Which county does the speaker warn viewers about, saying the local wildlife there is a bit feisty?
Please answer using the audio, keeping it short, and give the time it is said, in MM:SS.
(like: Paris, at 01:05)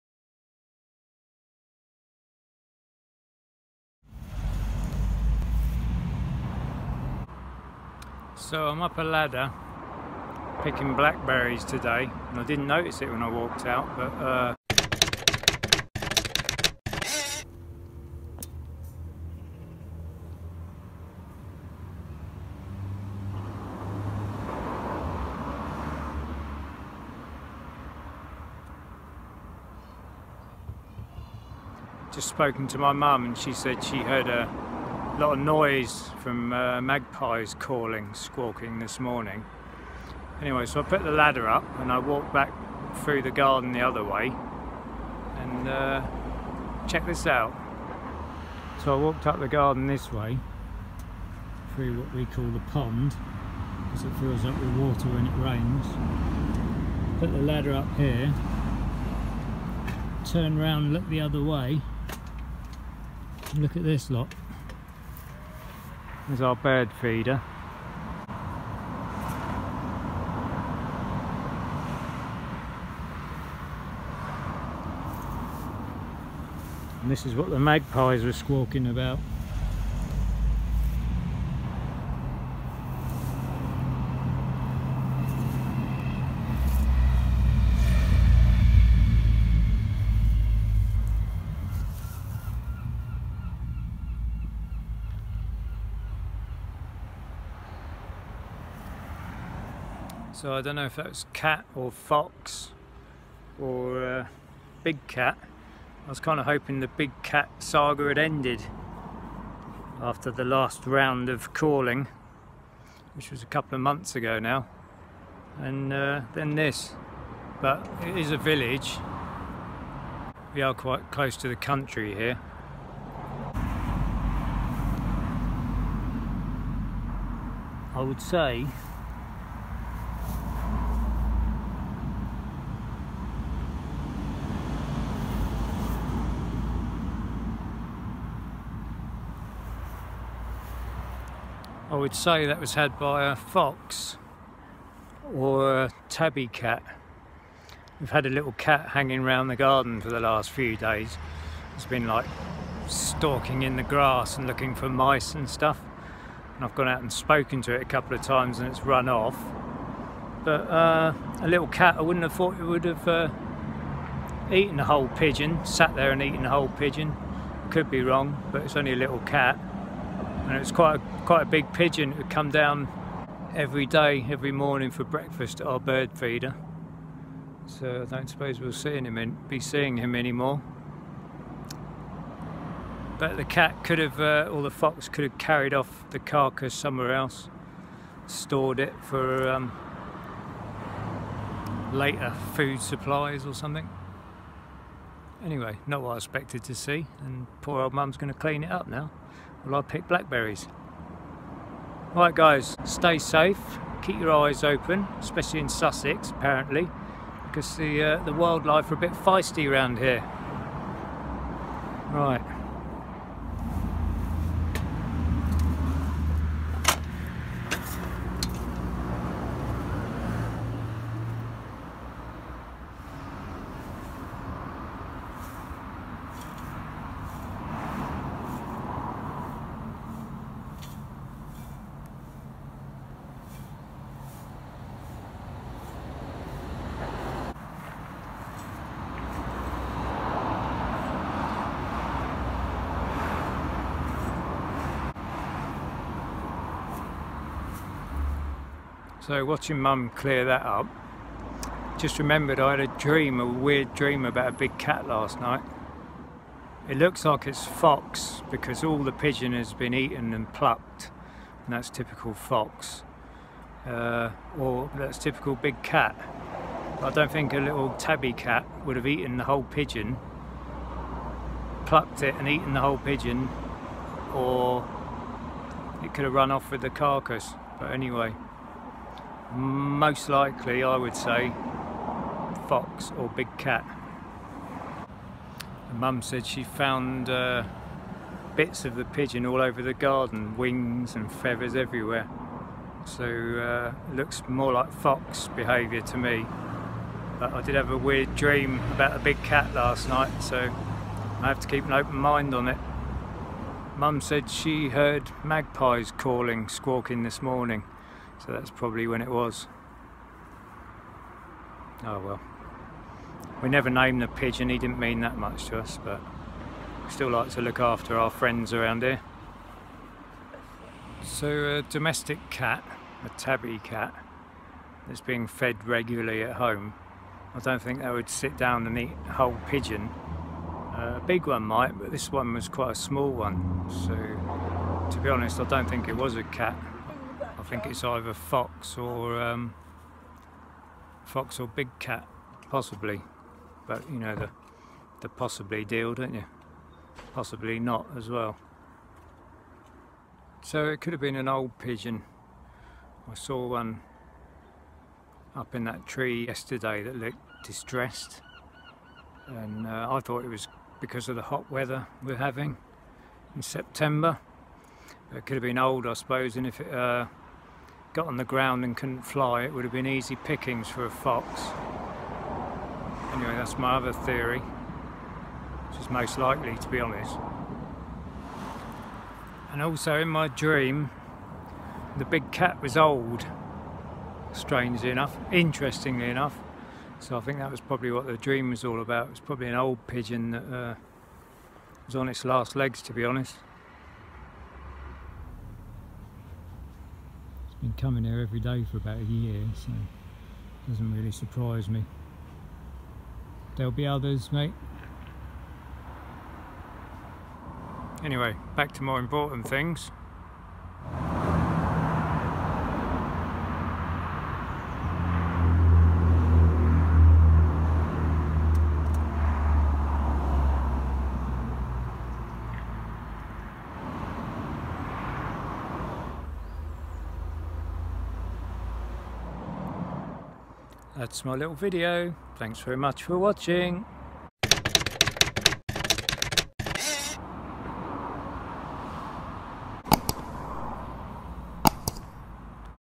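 Sussex, at 03:25.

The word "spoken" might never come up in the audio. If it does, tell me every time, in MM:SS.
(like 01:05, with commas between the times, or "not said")
00:32, 02:37.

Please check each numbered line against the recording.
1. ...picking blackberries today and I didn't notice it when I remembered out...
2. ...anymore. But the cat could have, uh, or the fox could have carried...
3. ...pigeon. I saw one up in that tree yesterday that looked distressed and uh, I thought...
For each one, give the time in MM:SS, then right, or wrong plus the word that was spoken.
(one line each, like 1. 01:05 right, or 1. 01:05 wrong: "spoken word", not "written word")
1. 00:10 wrong: "walked", not "remembered"
2. 03:00 right
3. 05:51 right.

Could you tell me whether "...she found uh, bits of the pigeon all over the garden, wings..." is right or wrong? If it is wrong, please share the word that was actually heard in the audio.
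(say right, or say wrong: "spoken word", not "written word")
right.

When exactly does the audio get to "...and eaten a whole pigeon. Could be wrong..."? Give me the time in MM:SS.
02:46.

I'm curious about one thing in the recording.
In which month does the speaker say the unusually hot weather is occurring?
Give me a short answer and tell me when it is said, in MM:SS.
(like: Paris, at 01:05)
September, at 06:03.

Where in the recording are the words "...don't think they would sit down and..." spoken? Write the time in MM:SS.
05:27.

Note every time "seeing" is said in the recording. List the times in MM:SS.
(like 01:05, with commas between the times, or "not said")
02:59.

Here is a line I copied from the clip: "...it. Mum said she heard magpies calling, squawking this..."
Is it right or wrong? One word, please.
right.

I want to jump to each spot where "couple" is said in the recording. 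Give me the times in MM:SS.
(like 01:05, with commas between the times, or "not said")
01:53, 02:37.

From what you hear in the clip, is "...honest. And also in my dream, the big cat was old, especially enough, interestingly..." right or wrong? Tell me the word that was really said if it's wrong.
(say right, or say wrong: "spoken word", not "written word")
wrong: "strangely", not "especially".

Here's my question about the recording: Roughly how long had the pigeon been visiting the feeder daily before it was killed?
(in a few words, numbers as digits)
About a year.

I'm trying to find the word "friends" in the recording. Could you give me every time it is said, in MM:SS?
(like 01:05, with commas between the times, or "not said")
05:18.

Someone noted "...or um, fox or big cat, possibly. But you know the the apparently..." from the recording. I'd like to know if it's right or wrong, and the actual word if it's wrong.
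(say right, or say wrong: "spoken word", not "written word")
wrong: "possibly", not "apparently".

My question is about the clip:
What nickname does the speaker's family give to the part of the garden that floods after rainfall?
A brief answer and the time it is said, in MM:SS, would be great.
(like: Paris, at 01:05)
The pond, at 00:52.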